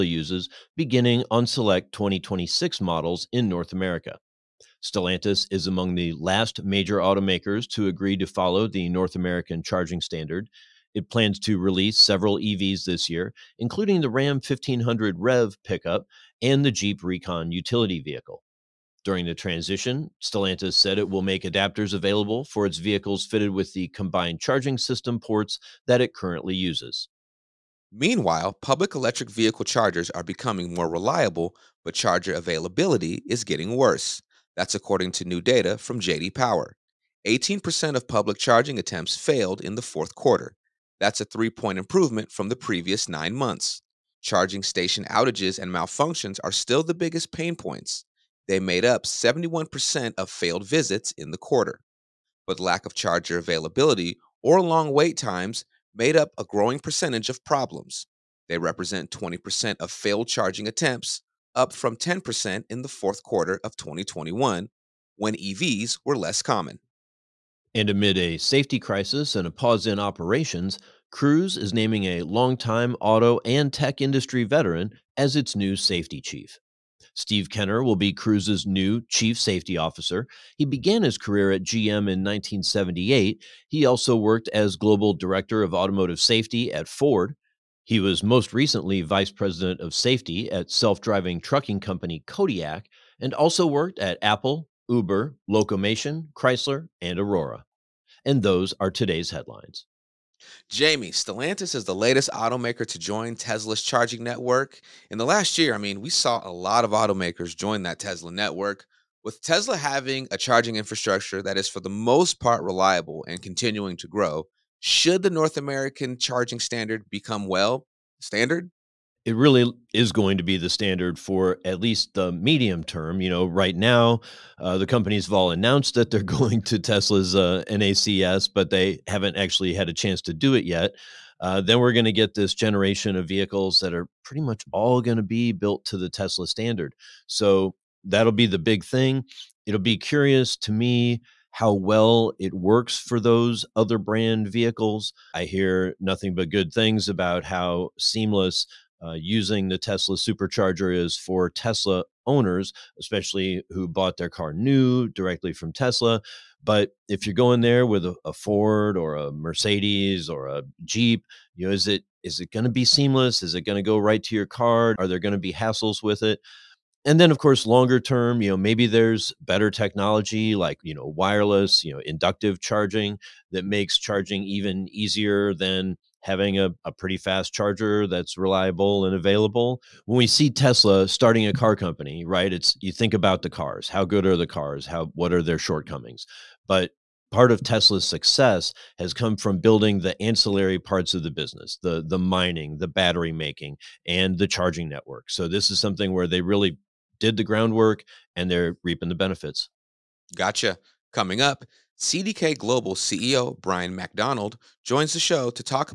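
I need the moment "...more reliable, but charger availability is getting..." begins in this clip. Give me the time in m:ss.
0:30.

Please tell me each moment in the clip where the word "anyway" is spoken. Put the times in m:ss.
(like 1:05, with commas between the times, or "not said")
not said.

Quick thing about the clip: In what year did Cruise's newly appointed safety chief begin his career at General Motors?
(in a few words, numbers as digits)
1978.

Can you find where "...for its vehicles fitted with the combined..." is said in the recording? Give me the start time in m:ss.
0:22.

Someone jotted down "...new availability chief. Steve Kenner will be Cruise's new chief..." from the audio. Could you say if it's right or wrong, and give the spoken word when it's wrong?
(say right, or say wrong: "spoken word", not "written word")
wrong: "safety", not "availability".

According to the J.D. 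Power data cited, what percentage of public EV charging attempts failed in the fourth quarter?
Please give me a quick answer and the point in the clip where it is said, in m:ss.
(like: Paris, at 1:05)
18%, at 0:37.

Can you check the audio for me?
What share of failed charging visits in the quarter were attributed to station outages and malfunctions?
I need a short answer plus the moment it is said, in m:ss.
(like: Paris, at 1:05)
71%, at 0:49.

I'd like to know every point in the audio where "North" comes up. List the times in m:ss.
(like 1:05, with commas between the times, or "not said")
0:03, 0:08, 1:55.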